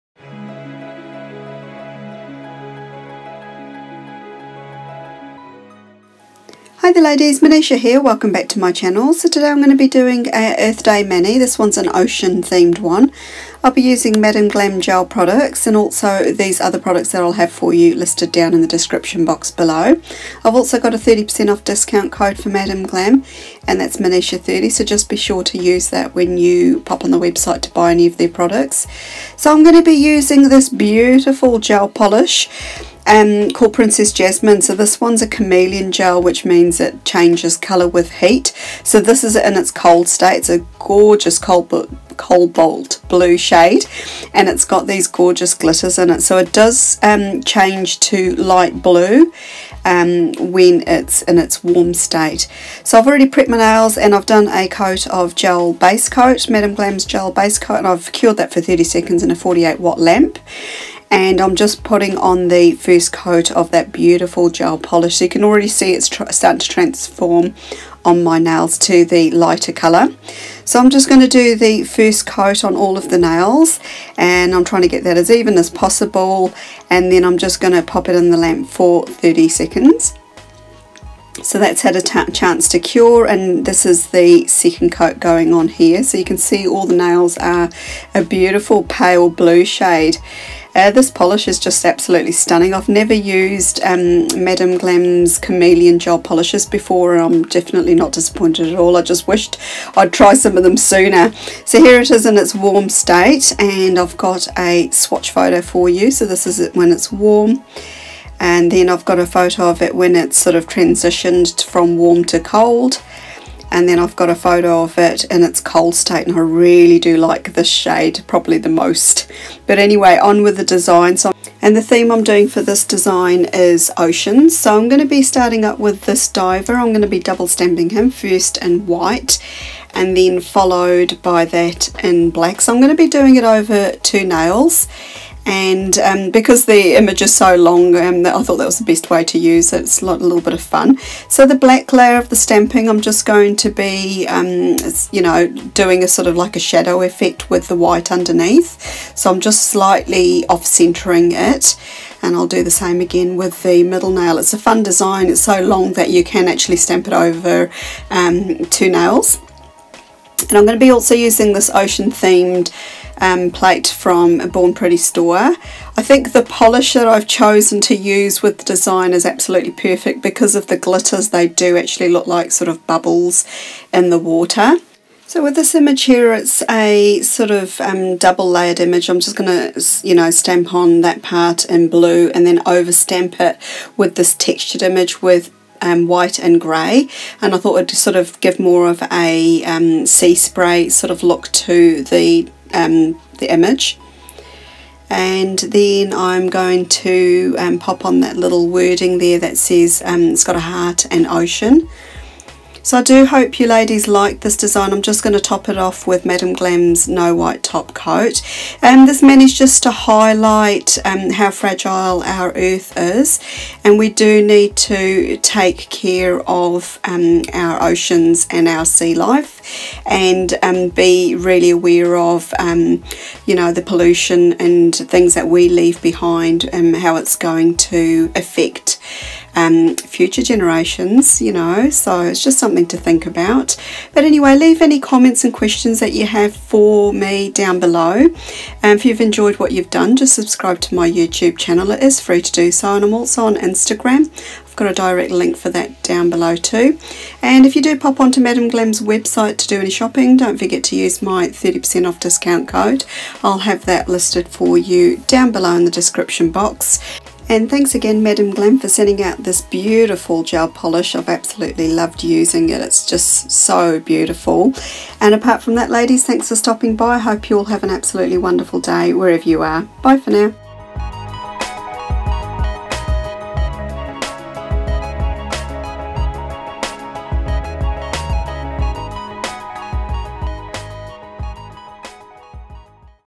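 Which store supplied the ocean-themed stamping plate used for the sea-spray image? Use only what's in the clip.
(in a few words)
Born Pretty.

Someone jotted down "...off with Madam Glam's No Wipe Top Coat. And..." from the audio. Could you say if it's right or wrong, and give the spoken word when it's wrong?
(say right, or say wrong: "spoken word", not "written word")
right.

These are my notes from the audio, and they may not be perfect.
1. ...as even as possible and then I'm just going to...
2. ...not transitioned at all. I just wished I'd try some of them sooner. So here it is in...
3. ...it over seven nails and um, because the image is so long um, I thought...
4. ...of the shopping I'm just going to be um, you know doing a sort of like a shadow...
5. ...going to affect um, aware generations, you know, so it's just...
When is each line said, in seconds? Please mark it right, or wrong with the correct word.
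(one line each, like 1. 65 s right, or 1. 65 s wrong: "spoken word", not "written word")
1. 75 s right
2. 97 s wrong: "disappointed", not "transitioned"
3. 133 s wrong: "two", not "seven"
4. 142 s wrong: "stamping", not "shopping"
5. 227 s wrong: "future", not "aware".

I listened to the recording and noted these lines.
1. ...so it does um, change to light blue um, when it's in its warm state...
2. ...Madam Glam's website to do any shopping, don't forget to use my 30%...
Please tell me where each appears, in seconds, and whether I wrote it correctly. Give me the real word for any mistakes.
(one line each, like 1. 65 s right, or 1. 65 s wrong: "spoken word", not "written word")
1. 46 s right
2. 248 s right.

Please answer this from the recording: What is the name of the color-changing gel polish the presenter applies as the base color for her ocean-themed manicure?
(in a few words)
Princess Jasmine.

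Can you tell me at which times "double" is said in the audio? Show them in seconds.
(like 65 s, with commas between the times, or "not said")
127 s, 178 s.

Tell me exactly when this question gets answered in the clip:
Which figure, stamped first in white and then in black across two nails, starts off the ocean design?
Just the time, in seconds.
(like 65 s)
126 s.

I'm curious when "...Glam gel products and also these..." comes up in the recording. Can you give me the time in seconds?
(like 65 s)
14 s.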